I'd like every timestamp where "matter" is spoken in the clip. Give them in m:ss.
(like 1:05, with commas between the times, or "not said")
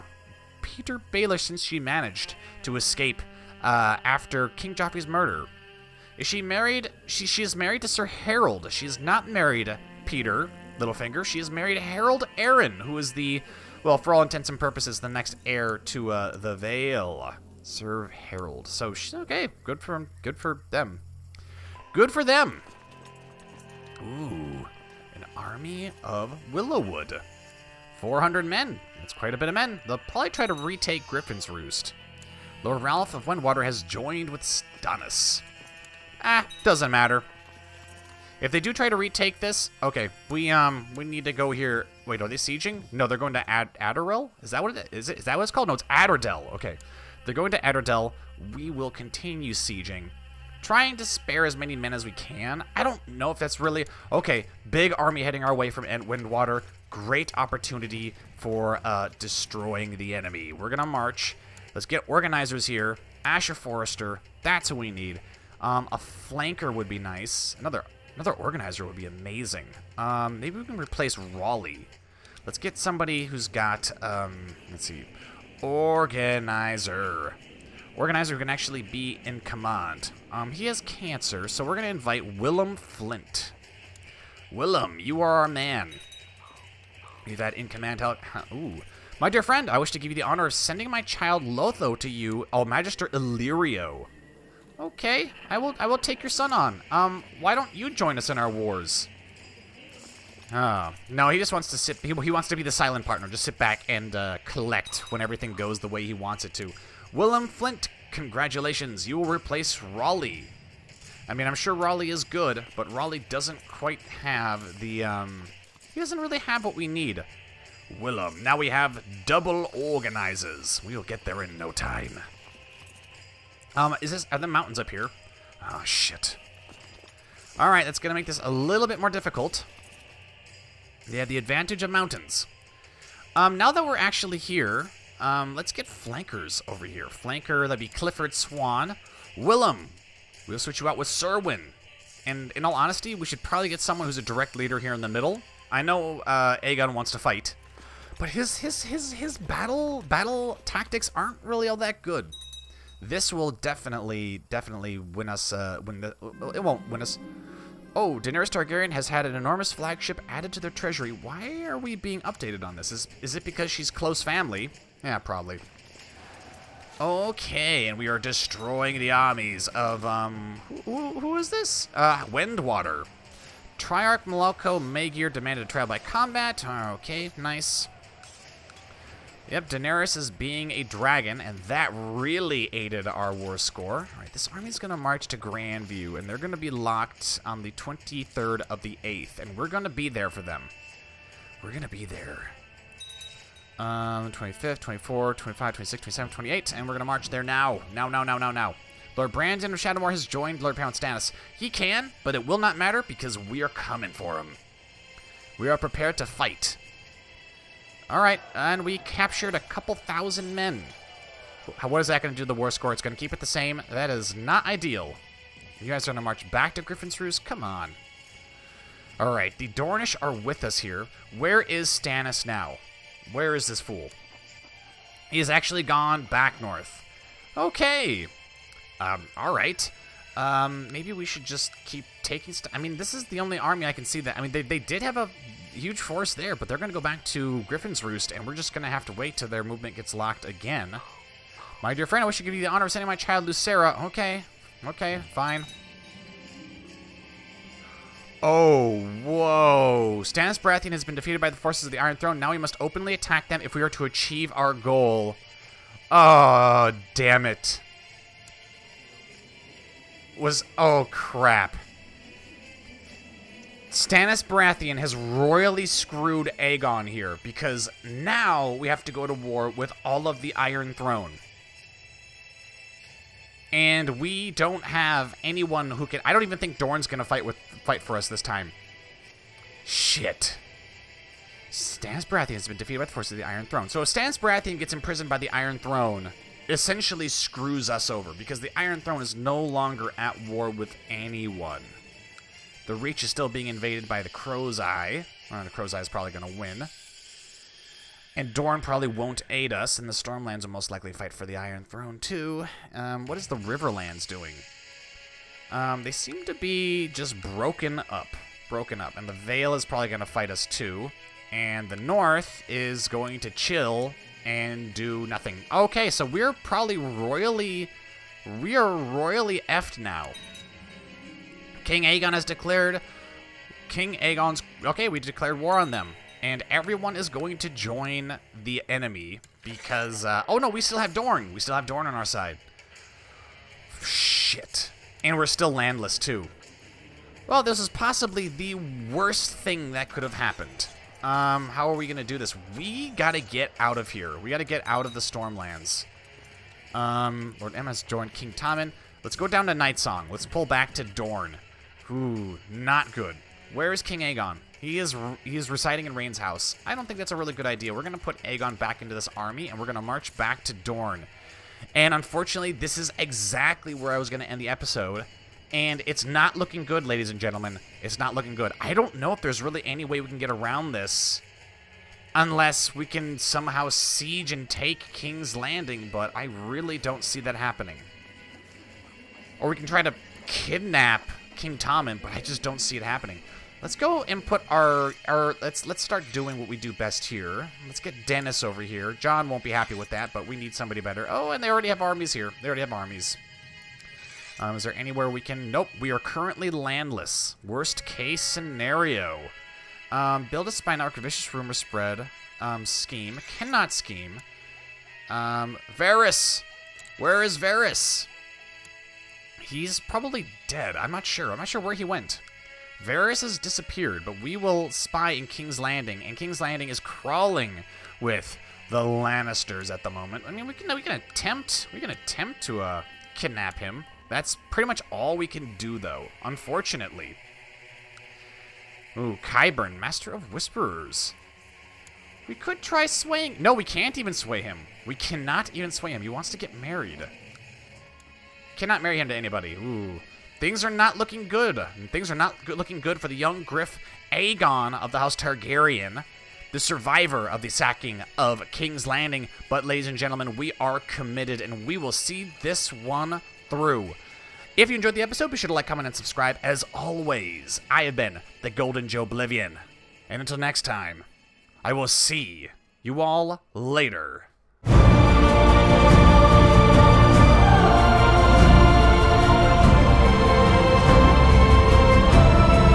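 0:36, 3:22.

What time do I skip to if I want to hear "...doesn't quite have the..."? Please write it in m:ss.
1:53.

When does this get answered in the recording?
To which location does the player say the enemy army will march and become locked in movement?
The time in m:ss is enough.
3:05.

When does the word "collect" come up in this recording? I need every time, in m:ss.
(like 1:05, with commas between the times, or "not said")
1:44.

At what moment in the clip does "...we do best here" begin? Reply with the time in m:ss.
6:26.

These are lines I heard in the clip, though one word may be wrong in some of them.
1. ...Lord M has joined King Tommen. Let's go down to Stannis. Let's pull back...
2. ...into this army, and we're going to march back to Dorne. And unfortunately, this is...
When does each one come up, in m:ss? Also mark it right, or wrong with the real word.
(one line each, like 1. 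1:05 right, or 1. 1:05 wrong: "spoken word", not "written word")
1. 5:47 wrong: "Nightsong", not "Stannis"
2. 5:59 right.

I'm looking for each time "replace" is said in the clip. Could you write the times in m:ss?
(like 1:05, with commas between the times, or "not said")
1:10, 1:49.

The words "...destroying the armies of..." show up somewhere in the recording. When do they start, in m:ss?
2:48.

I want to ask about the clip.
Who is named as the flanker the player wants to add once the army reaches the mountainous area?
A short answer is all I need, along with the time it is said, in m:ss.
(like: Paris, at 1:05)
Clifford Swan, at 2:17.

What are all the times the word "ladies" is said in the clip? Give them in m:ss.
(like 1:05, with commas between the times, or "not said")
6:07, 7:29.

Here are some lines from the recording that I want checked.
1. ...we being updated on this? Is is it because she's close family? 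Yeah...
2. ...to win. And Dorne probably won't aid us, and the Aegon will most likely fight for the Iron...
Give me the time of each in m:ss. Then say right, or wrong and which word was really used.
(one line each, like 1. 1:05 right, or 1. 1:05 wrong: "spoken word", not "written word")
1. 2:41 right
2. 4:56 wrong: "Stormlands", not "Aegon".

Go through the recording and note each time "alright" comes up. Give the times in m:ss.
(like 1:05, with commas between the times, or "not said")
3:28, 3:39, 3:49.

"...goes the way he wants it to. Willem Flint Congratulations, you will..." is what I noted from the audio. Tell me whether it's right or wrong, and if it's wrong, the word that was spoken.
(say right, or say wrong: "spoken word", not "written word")
right.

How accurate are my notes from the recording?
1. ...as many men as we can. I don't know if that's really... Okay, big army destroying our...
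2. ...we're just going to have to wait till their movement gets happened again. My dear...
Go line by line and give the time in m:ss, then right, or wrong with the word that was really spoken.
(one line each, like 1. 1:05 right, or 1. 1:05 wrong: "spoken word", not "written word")
1. 0:51 wrong: "heading", not "destroying"
2. 3:58 wrong: "locked", not "happened".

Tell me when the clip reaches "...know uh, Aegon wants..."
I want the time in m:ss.
2:25.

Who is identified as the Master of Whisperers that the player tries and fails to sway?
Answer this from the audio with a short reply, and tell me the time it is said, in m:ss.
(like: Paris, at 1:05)
Qyburn, at 7:09.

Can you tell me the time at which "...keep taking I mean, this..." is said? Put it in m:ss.
3:51.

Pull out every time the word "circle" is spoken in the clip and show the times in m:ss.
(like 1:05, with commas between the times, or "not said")
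not said.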